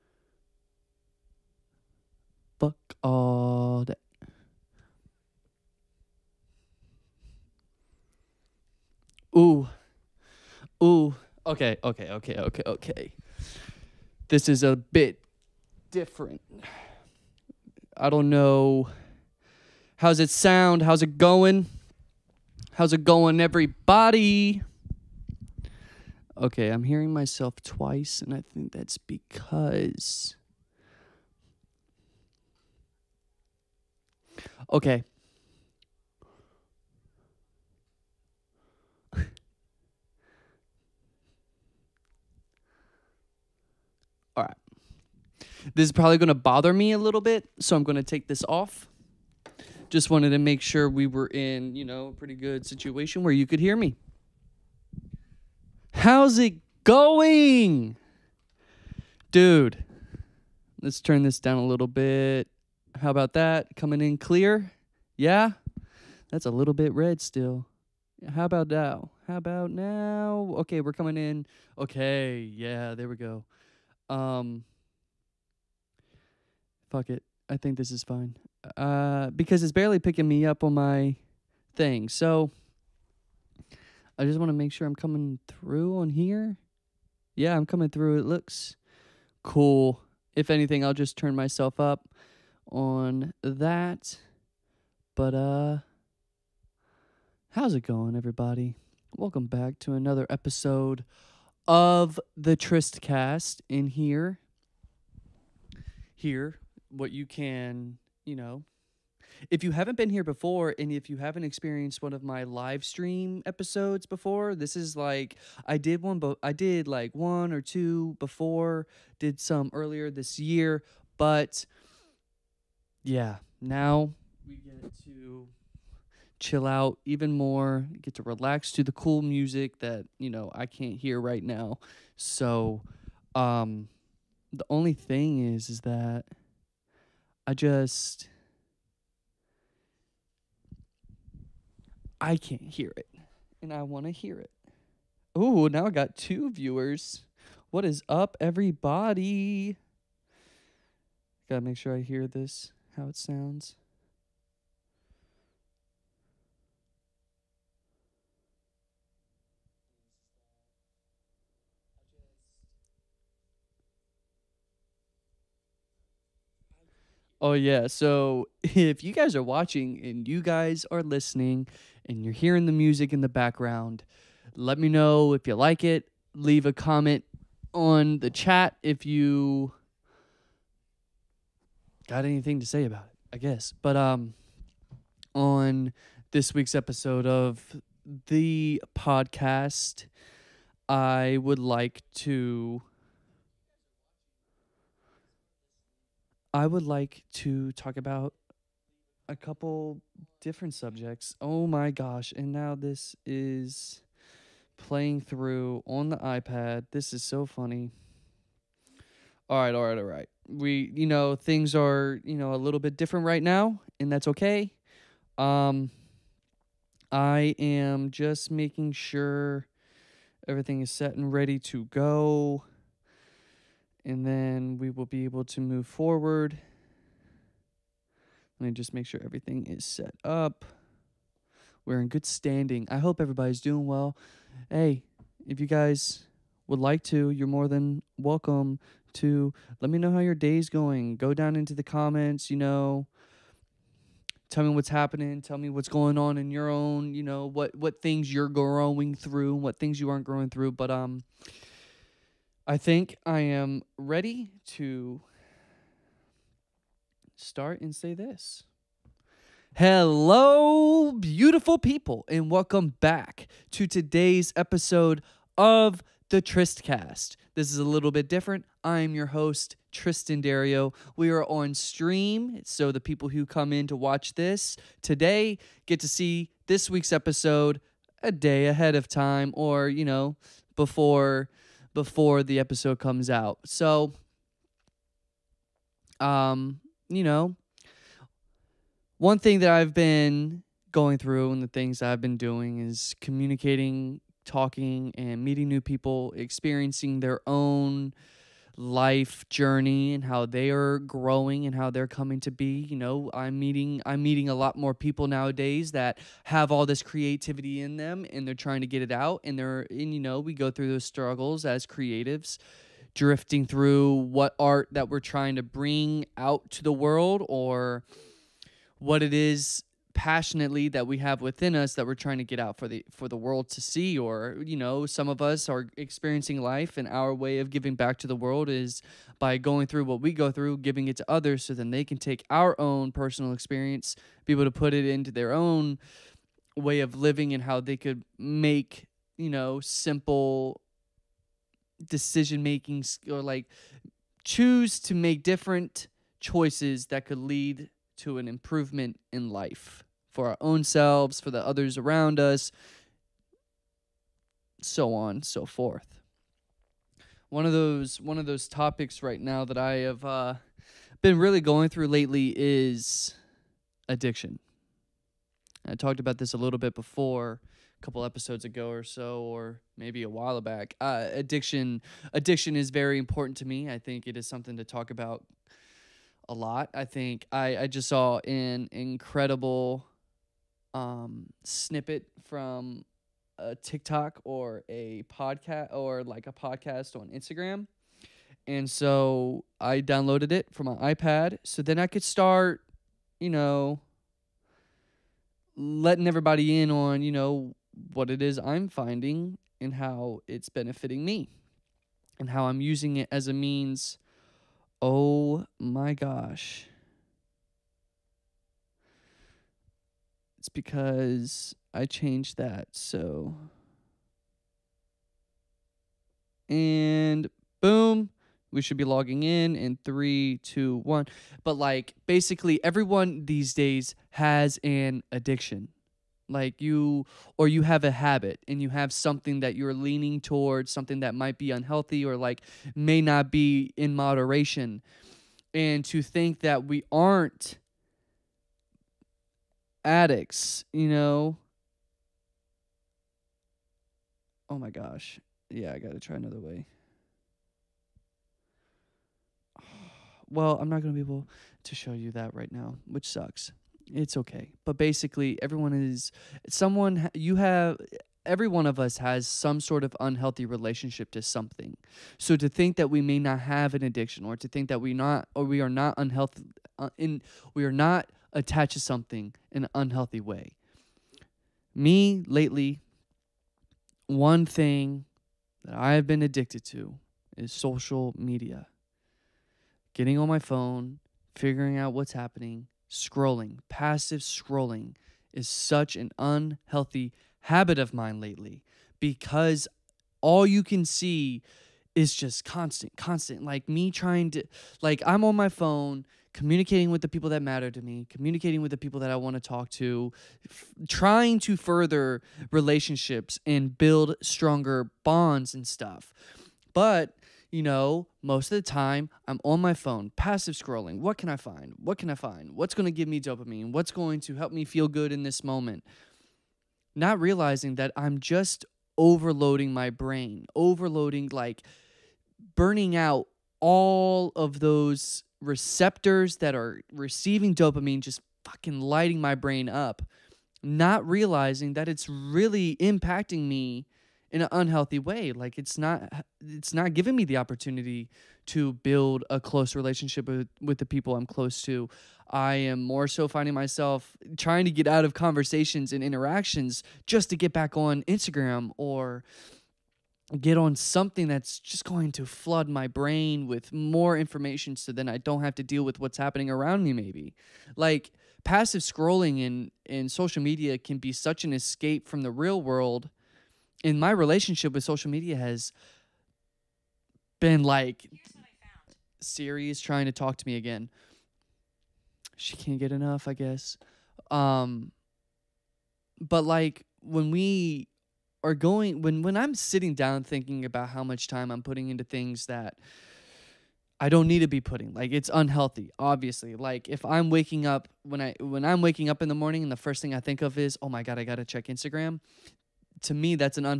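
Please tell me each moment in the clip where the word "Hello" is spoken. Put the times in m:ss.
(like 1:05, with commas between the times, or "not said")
4:19.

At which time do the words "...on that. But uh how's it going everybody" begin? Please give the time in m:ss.
1:32.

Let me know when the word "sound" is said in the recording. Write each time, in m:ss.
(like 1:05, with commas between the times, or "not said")
0:20, 2:33.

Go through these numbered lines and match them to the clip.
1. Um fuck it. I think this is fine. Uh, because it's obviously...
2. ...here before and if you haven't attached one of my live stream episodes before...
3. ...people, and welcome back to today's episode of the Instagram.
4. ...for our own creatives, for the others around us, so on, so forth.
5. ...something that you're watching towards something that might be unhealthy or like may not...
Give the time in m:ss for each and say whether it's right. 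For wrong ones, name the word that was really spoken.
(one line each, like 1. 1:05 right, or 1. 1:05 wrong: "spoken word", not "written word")
1. 1:14 wrong: "barely", not "obviously"
2. 1:50 wrong: "experienced", not "attached"
3. 4:21 wrong: "Tristcast", not "Instagram"
4. 5:50 wrong: "selves", not "creatives"
5. 7:09 wrong: "leaning", not "watching".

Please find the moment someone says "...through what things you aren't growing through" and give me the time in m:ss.
4:09.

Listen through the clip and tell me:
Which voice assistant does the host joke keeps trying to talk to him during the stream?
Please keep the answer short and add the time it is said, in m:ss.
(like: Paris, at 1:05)
Siri, at 9:29.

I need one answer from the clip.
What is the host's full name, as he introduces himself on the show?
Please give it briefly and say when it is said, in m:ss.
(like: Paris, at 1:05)
Triston Derieux, at 4:29.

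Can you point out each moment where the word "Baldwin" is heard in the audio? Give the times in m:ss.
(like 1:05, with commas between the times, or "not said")
not said.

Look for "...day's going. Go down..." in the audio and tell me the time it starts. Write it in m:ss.
4:00.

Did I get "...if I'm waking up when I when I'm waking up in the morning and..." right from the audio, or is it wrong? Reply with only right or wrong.
right.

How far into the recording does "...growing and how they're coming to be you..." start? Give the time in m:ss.
5:00.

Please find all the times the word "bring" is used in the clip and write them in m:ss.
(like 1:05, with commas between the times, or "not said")
5:15.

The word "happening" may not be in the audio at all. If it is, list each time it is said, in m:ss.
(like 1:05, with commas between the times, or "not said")
4:04, 8:02, 9:16.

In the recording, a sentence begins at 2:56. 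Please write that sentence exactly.
Leave a comment on the chat if you got anything to say about it, I guess.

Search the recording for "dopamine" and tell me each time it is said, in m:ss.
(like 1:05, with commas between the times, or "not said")
8:33, 8:47.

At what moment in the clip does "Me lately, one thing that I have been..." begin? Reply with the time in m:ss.
7:51.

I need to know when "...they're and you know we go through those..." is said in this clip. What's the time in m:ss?
5:09.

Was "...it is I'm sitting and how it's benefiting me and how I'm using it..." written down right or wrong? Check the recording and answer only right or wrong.
wrong.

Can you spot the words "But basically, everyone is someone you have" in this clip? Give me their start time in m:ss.
7:34.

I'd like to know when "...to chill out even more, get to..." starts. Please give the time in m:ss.
2:05.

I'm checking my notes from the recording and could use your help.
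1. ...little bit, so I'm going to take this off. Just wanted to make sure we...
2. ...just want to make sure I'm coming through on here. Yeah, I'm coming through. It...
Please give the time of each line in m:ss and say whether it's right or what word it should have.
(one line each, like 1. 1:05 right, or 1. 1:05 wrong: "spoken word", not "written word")
1. 0:46 right
2. 1:24 right.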